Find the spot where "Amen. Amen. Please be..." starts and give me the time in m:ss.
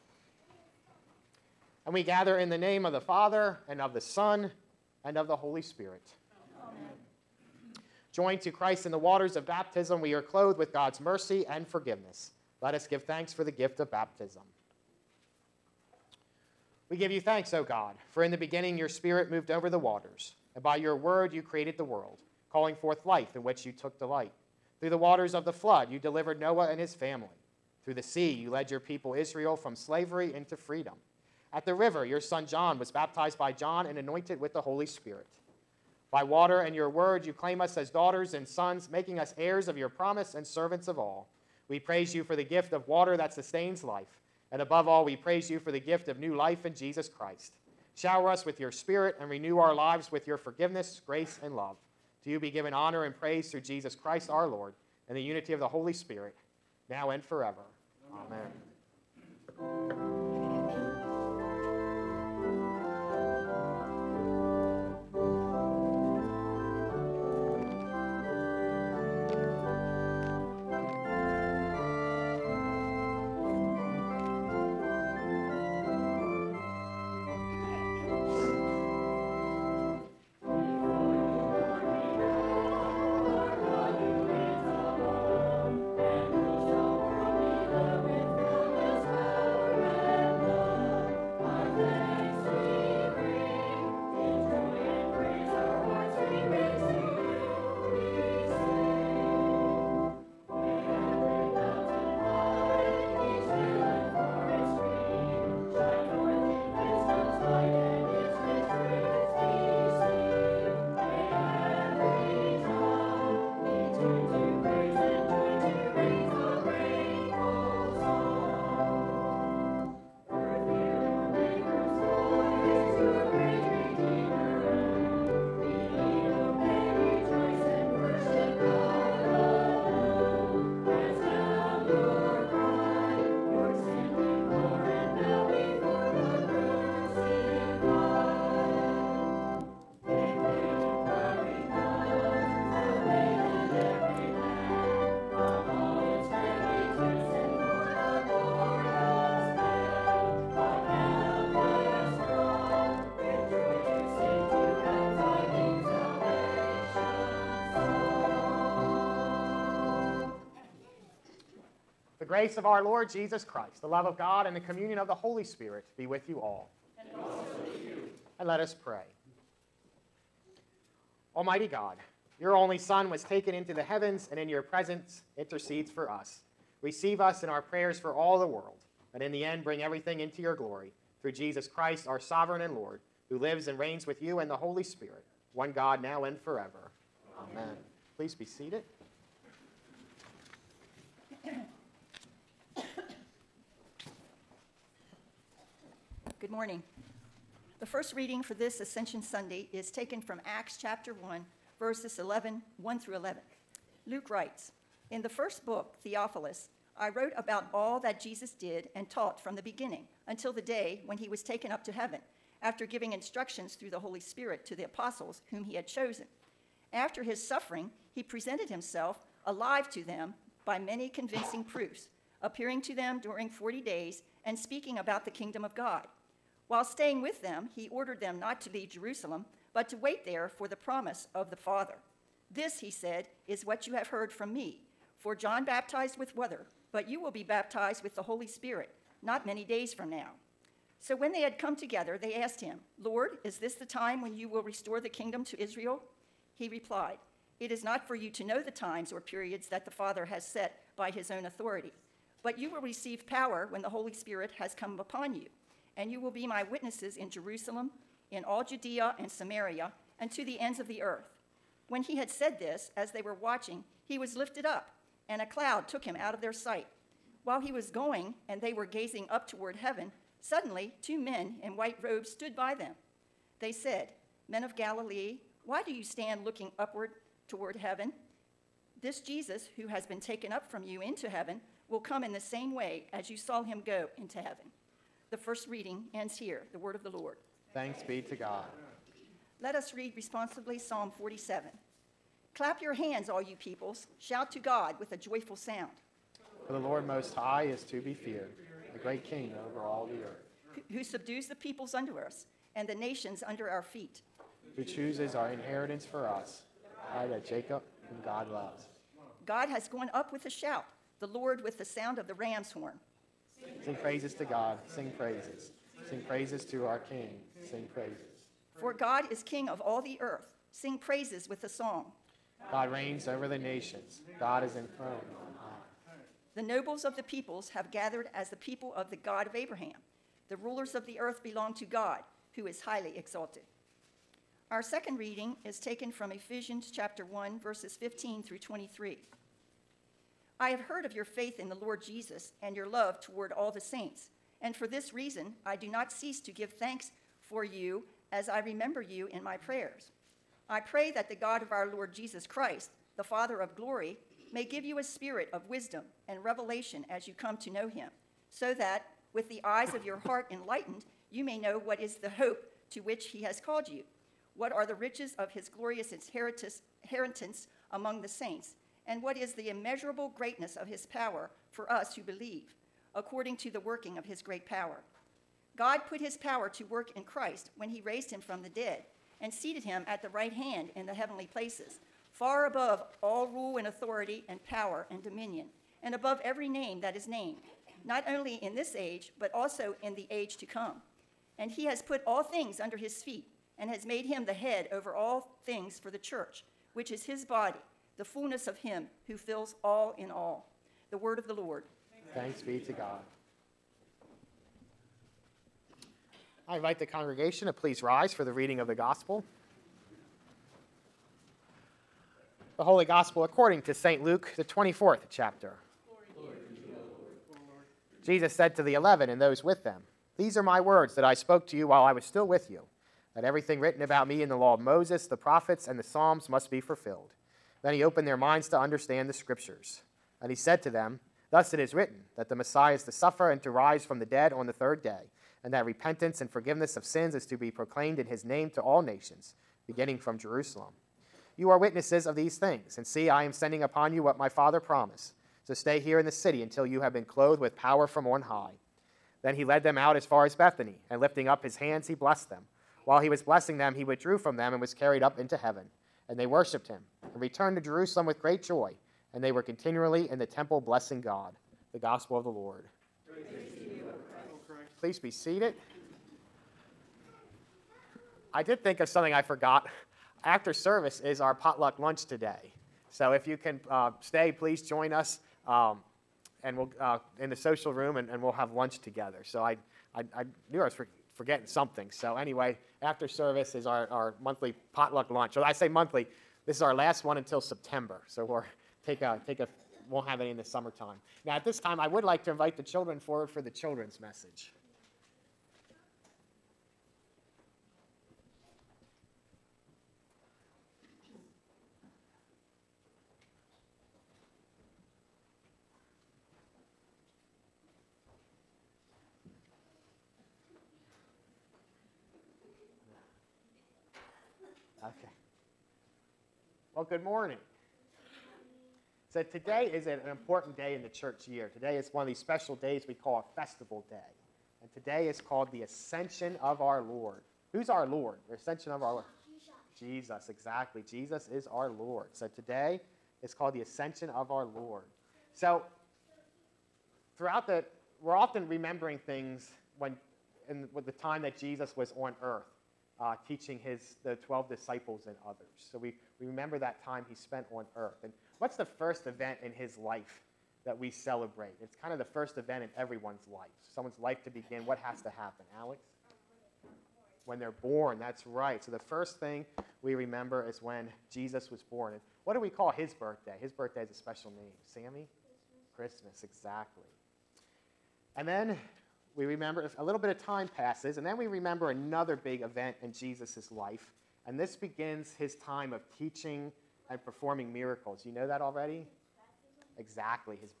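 3:07.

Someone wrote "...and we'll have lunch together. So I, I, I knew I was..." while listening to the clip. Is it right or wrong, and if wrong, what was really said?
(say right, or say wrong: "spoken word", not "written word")
right.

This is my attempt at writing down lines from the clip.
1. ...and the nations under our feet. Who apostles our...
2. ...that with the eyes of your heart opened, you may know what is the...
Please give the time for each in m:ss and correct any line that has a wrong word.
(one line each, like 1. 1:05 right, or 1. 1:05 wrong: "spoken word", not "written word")
1. 5:02 wrong: "chooses", not "apostles"
2. 5:58 wrong: "enlightened", not "opened".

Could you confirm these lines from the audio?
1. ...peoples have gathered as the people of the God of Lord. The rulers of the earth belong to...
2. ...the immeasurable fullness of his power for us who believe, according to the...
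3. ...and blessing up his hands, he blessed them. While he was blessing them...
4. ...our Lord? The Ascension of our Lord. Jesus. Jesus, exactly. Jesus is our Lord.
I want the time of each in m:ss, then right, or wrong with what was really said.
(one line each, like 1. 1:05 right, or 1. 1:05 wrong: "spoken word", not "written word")
1. 5:27 wrong: "Abraham", not "Lord"
2. 6:09 wrong: "greatness", not "fullness"
3. 7:31 wrong: "lifting", not "blessing"
4. 8:47 right.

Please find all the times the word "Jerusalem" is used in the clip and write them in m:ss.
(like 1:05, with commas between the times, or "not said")
3:48, 4:17, 7:20, 7:37.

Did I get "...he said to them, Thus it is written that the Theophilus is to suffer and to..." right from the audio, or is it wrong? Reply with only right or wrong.
wrong.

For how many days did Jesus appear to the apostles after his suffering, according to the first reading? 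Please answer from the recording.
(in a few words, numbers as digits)
40.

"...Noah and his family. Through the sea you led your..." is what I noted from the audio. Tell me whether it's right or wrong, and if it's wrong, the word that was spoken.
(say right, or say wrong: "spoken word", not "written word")
right.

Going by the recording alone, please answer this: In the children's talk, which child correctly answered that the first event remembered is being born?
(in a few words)
Alex.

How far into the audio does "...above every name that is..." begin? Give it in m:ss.
6:26.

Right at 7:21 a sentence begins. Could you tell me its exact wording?
You are witnesses of these things, and see, I am sending upon you what my Father promised.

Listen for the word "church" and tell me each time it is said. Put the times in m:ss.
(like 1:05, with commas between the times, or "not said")
6:36, 8:41.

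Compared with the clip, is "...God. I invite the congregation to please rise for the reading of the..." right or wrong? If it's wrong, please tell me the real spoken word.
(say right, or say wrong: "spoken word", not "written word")
right.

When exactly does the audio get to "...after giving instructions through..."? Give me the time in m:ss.
3:32.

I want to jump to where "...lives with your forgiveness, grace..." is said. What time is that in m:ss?
0:49.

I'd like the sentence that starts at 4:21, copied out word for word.
When he had said this, as they were watching, he was lifted up, and a cloud took him out of their sight.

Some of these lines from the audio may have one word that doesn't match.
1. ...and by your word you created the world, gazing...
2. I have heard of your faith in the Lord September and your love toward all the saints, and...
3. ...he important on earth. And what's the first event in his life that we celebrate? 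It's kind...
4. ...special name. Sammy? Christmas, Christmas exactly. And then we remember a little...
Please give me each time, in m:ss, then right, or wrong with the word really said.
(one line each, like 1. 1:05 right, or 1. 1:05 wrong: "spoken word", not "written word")
1. 0:20 wrong: "calling", not "gazing"
2. 5:40 wrong: "Jesus", not "September"
3. 9:07 wrong: "spent", not "important"
4. 9:24 right.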